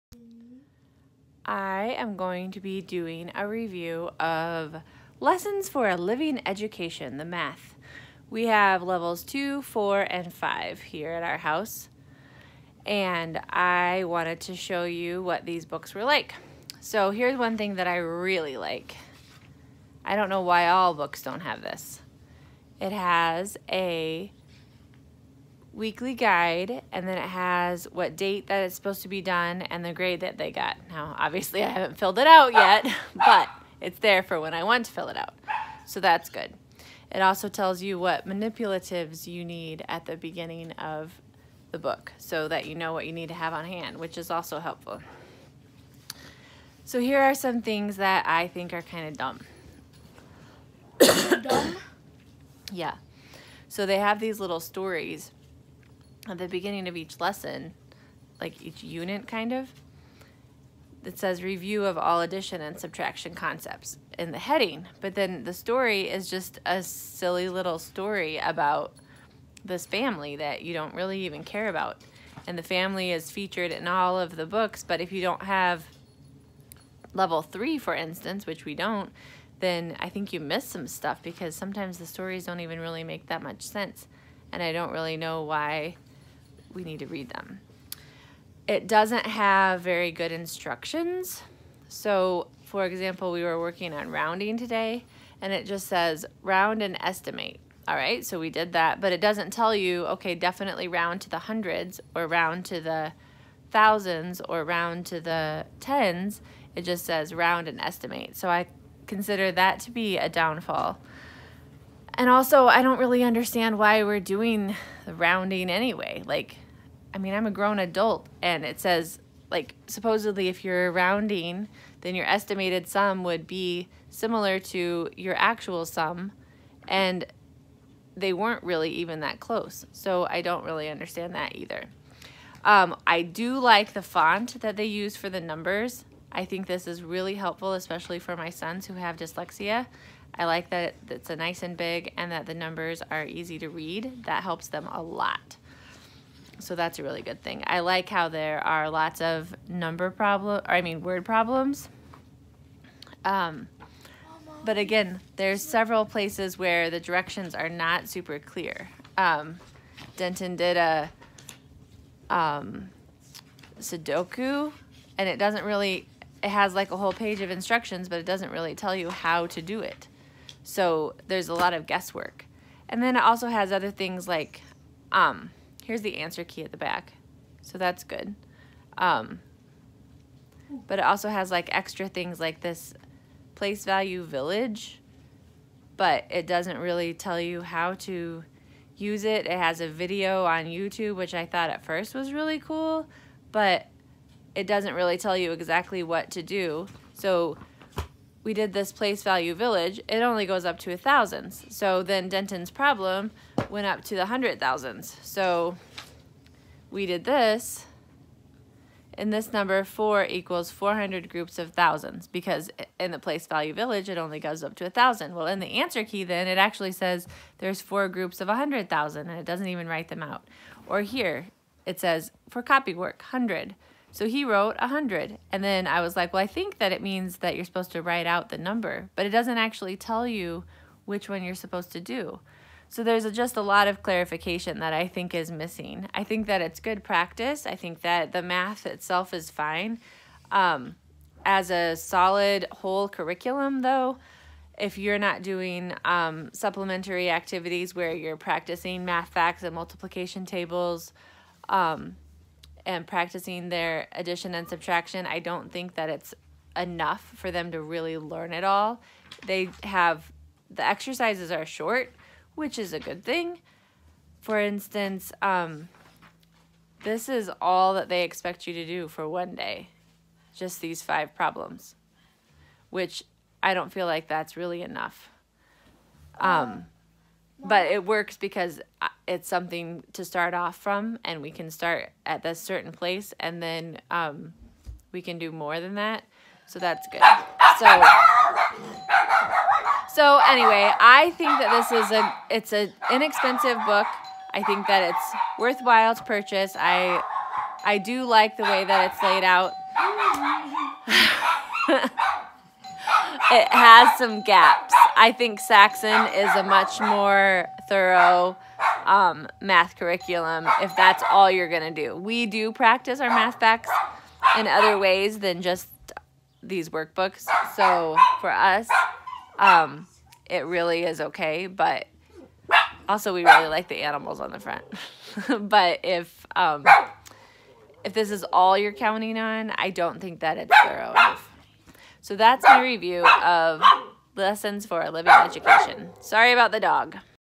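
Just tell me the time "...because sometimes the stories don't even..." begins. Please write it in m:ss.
1:21.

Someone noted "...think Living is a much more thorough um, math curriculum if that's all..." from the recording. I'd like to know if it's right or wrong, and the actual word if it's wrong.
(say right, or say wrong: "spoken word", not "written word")
wrong: "Saxon", not "Living".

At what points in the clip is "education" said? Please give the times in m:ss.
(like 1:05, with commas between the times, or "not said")
0:06, 5:35.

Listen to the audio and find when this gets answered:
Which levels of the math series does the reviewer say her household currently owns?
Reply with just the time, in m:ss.
0:09.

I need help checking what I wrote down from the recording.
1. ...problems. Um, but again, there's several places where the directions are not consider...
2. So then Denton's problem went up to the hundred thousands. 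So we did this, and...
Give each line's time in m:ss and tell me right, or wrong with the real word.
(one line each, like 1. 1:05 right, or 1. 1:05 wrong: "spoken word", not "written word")
1. 2:31 wrong: "super", not "consider"
2. 3:21 right.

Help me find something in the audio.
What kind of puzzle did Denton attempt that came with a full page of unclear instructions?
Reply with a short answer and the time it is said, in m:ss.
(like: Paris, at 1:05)
Sudoku, at 2:43.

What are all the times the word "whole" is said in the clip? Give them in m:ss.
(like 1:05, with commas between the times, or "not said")
2:46, 4:02.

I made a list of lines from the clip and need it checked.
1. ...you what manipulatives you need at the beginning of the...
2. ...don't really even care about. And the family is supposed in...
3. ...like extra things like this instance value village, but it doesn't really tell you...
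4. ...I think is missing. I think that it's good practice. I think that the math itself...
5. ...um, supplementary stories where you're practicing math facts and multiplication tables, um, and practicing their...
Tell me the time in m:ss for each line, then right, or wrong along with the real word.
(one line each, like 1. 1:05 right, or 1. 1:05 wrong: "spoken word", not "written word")
1. 0:37 right
2. 1:10 wrong: "featured", not "supposed"
3. 3:01 wrong: "place", not "instance"
4. 3:54 right
5. 4:06 wrong: "activities", not "stories".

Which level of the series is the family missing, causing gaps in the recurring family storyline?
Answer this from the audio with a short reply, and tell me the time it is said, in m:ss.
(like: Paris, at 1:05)
3, at 1:17.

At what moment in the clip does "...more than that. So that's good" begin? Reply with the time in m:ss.
4:45.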